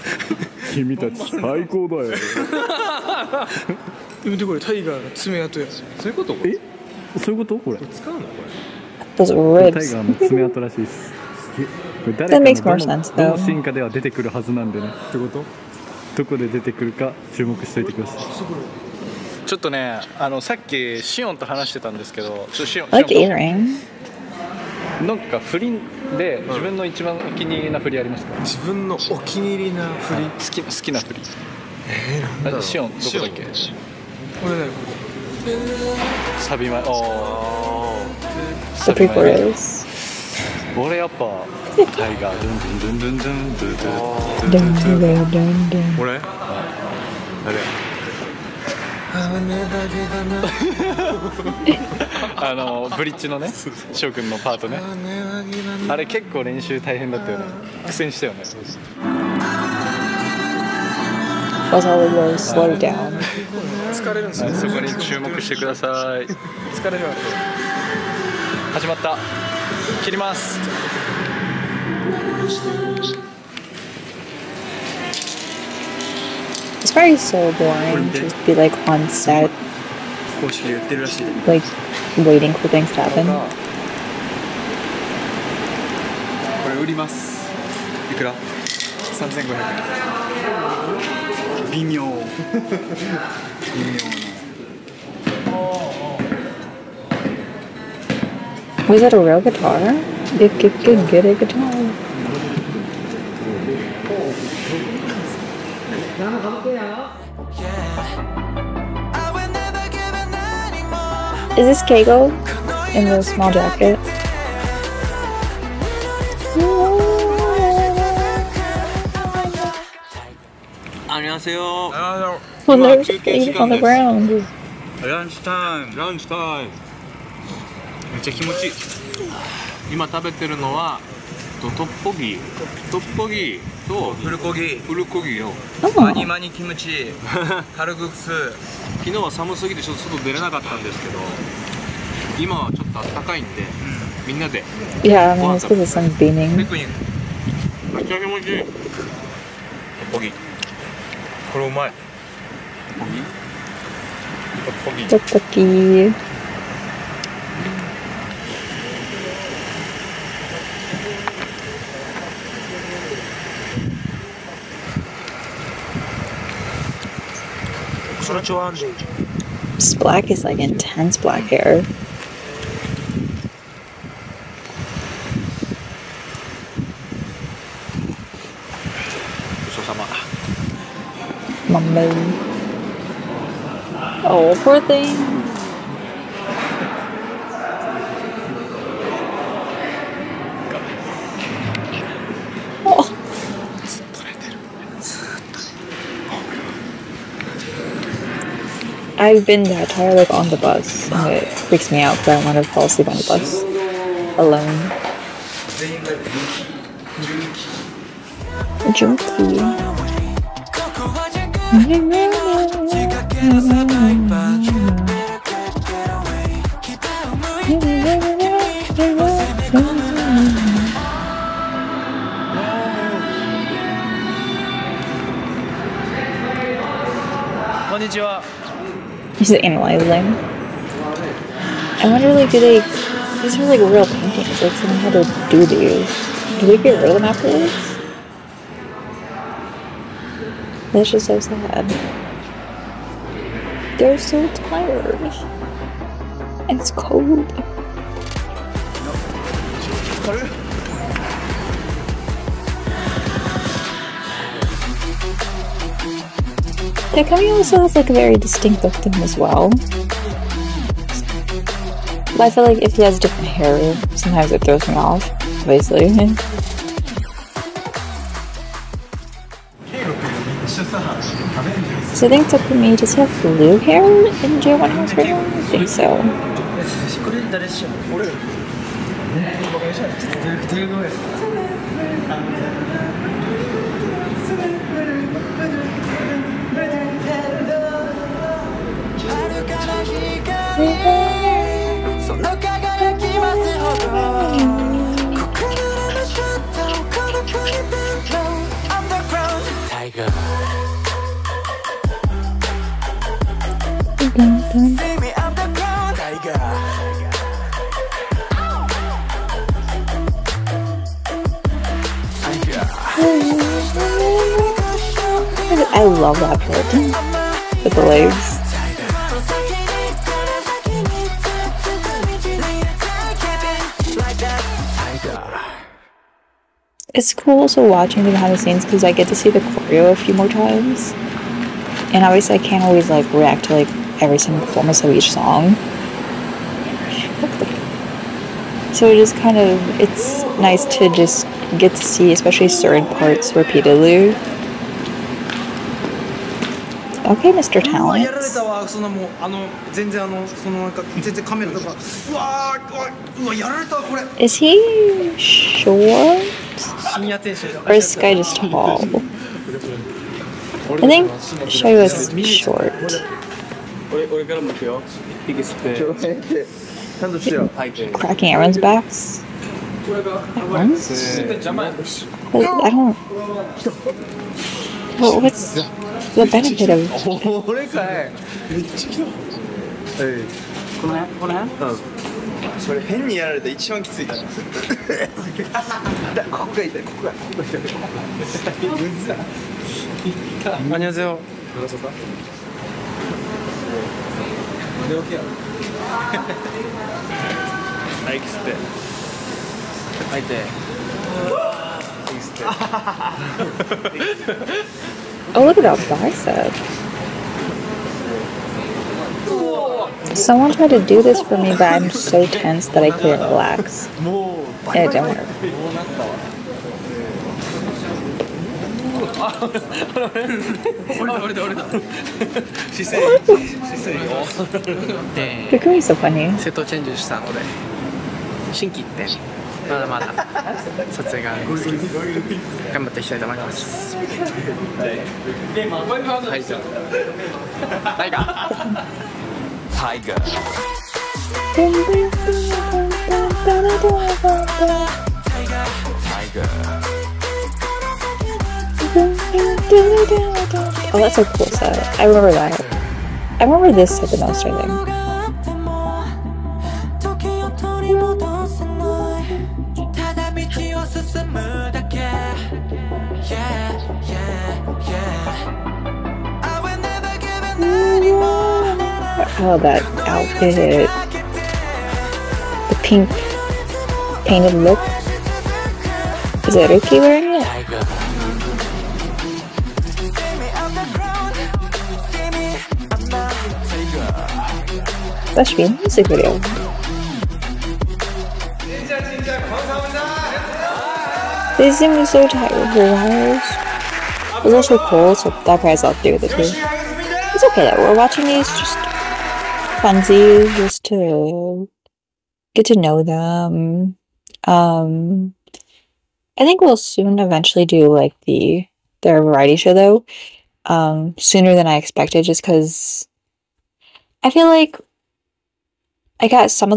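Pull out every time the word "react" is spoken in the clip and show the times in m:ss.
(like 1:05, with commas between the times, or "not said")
5:33.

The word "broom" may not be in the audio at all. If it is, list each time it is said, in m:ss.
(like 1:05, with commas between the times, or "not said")
not said.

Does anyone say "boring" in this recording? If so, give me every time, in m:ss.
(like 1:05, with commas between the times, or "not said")
1:17.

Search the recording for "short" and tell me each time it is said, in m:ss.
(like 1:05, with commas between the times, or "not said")
5:55, 6:02.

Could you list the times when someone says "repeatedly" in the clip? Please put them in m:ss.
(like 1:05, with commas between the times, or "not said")
5:43.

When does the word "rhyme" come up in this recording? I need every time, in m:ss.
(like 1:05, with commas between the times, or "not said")
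not said.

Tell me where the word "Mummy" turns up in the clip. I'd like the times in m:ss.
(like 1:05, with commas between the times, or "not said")
3:01.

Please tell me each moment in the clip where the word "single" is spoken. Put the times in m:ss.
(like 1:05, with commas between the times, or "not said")
5:34.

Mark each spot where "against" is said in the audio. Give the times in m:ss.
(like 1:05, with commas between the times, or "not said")
not said.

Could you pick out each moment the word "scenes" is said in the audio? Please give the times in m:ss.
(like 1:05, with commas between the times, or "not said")
5:28.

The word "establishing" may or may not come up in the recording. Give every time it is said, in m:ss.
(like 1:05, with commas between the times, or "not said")
not said.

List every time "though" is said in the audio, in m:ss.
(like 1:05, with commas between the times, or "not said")
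0:13, 8:29.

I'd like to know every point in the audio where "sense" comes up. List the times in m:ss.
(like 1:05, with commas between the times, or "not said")
0:12.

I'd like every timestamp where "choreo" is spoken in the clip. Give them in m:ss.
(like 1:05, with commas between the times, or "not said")
5:29.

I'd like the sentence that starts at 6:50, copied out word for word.
Someone tried to do this for me, but I'm so tense that I couldn't relax.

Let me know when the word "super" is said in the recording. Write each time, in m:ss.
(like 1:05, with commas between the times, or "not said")
not said.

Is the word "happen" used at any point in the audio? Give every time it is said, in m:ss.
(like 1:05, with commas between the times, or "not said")
1:23.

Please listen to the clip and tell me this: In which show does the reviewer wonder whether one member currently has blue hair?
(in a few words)
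JO1 House.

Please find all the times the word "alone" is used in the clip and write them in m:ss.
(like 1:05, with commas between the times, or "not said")
3:24.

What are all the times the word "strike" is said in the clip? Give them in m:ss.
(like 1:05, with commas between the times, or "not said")
not said.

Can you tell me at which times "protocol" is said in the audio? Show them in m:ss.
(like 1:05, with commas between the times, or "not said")
not said.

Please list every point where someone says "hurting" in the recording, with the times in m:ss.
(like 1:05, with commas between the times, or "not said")
not said.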